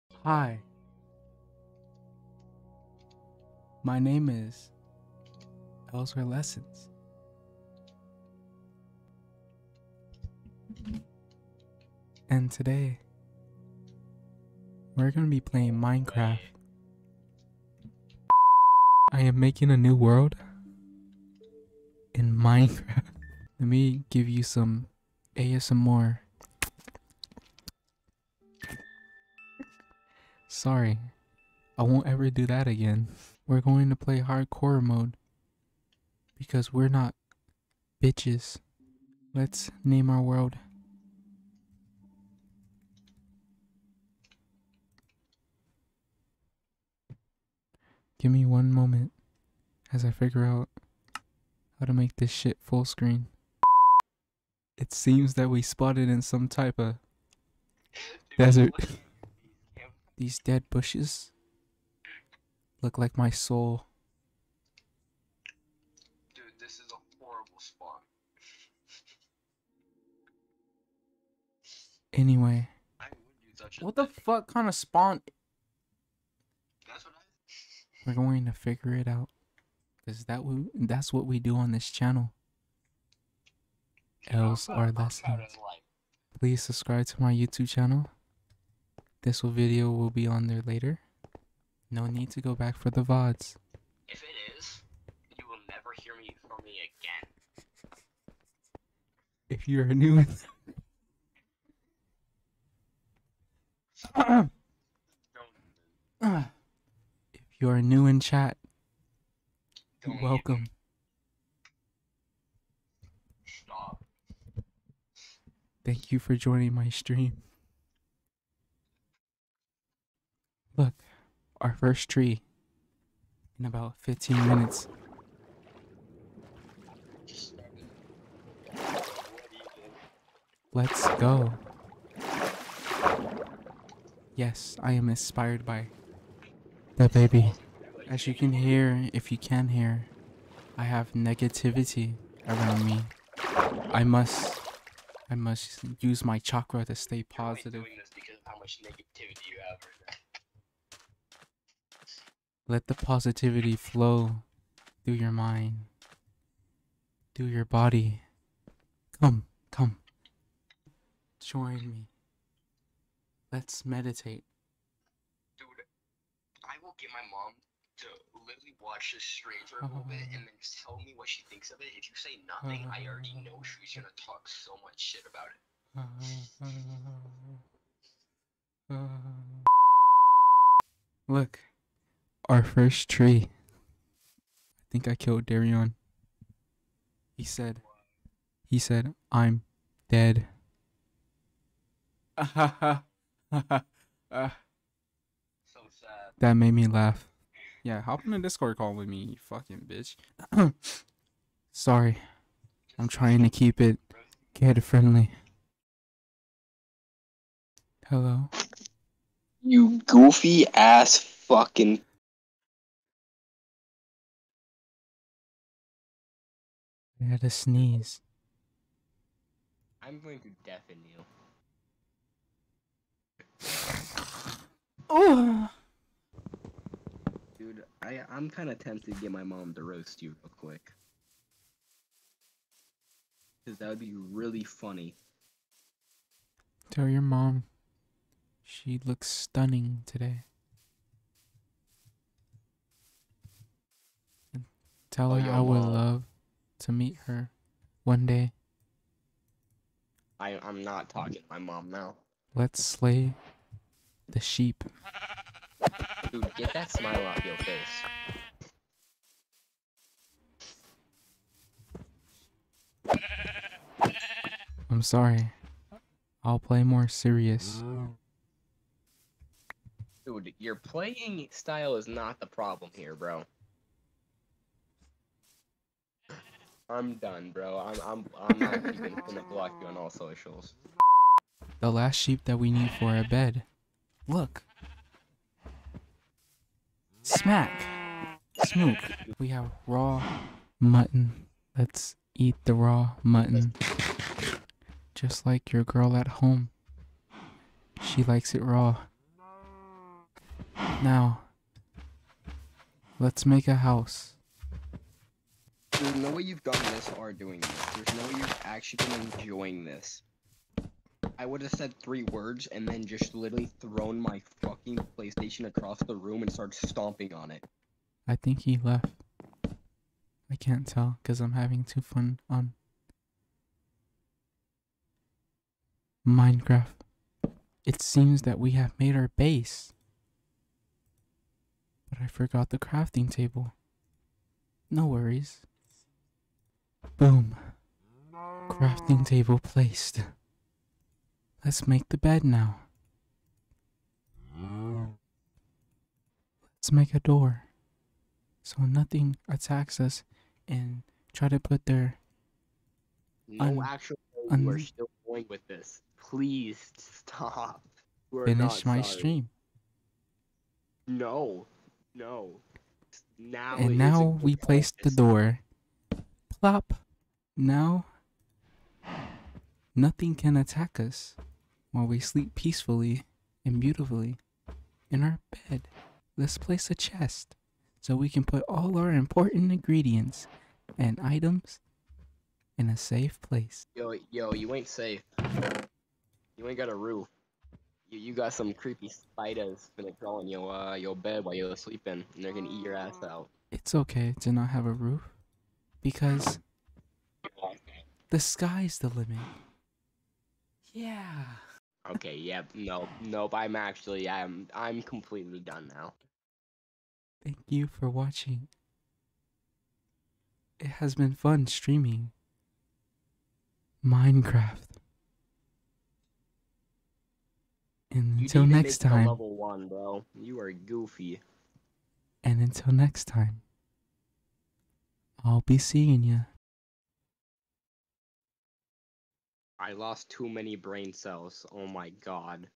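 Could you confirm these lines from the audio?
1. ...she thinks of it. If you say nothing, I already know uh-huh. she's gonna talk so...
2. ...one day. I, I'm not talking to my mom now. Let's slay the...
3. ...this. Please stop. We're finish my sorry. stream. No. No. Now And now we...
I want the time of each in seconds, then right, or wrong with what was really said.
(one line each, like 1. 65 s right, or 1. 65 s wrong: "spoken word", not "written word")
1. 171 s right
2. 248 s right
3. 355 s right.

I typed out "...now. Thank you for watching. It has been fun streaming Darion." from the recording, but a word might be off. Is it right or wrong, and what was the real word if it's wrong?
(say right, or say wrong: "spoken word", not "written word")
wrong: "Minecraft", not "Darion".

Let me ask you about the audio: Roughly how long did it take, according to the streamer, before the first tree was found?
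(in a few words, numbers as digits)
About 15 minutes.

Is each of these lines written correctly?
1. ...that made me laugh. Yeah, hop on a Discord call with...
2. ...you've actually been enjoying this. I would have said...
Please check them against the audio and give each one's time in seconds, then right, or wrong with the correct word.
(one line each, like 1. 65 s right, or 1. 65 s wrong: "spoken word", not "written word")
1. 192 s right
2. 308 s right.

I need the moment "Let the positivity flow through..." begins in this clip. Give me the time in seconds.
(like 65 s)
152 s.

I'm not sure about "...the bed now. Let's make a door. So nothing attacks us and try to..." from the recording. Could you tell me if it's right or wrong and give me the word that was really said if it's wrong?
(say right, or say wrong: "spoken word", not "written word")
right.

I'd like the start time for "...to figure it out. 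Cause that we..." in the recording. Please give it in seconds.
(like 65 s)
78 s.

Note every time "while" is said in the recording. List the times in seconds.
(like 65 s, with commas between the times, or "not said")
371 s, 391 s.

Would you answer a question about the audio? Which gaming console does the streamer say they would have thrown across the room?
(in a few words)
PlayStation.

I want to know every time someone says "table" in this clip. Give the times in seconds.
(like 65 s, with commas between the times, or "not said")
333 s, 339 s.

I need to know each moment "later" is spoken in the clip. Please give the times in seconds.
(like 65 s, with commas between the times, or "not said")
90 s.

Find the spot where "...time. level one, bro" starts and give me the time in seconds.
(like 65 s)
418 s.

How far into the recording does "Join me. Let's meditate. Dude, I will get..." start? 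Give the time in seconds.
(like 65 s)
161 s.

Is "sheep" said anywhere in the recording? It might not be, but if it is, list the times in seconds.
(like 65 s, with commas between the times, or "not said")
254 s, 282 s.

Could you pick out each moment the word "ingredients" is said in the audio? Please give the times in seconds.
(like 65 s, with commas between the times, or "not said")
379 s.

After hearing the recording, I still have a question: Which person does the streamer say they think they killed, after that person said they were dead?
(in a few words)
Darion.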